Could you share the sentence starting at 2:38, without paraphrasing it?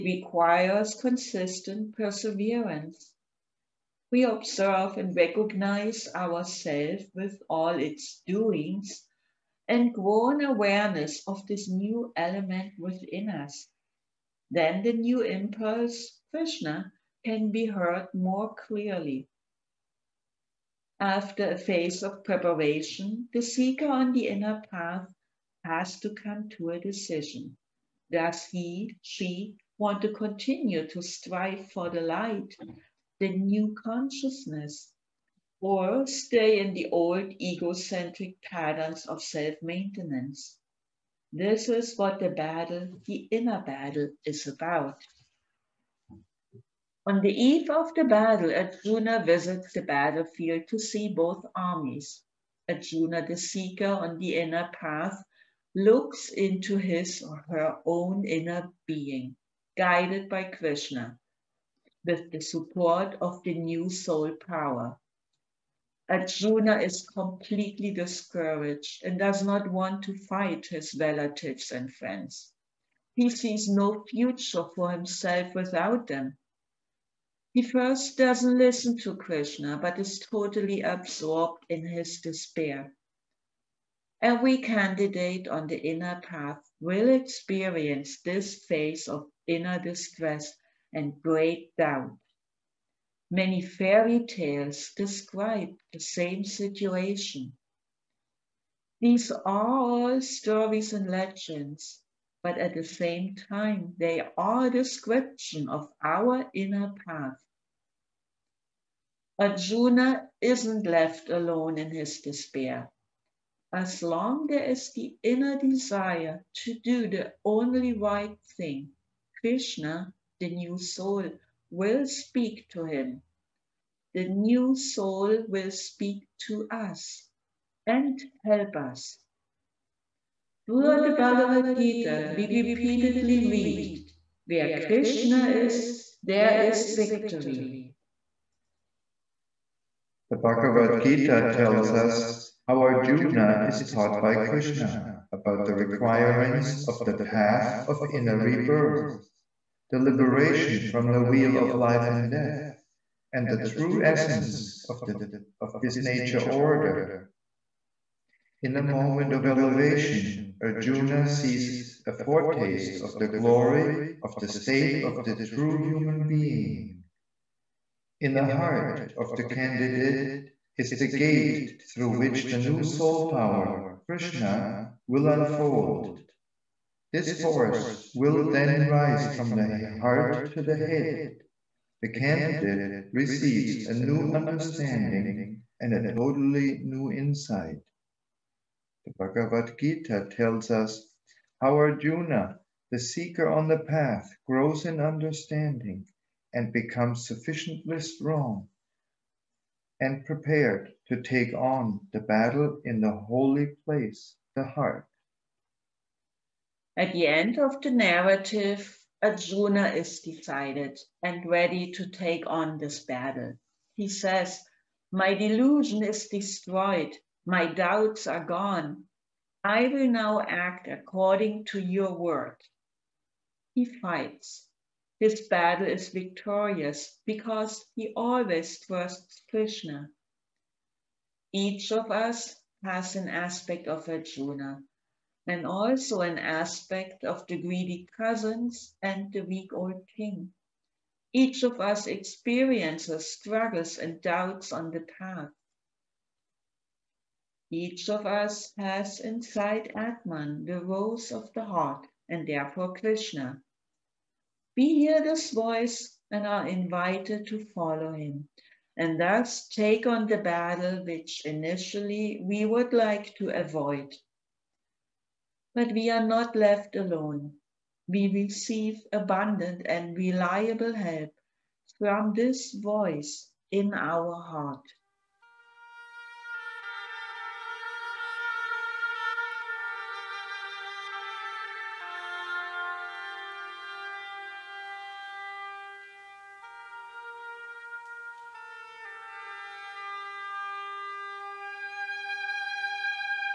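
In a moment of elevation, Arjuna sees a foretaste of the glory of the state of the true human being.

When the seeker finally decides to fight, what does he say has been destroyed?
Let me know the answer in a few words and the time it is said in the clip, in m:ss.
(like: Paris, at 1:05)
My delusion, at 3:35.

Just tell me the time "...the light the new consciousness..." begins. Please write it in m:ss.
0:31.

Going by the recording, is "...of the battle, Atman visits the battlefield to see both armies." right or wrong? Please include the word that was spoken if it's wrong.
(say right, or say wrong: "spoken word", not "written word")
wrong: "Arjuna", not "Atman".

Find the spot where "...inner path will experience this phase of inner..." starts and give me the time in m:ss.
1:25.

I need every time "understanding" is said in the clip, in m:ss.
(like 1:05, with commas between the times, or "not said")
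3:04, 3:14.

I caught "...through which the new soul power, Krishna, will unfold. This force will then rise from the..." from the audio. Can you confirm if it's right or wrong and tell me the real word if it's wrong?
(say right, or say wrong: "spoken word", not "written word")
right.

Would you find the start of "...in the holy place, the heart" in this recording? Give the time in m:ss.
3:22.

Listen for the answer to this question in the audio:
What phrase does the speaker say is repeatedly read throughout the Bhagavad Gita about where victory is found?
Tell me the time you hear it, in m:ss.
2:14.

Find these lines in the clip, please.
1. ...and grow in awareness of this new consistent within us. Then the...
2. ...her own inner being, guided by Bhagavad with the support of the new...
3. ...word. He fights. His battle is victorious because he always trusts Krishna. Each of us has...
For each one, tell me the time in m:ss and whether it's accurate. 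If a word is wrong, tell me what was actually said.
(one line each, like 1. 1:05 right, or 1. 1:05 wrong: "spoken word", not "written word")
1. 0:09 wrong: "element", not "consistent"
2. 0:57 wrong: "Krishna", not "Bhagavad"
3. 3:42 right.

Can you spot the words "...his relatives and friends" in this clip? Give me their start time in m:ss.
1:10.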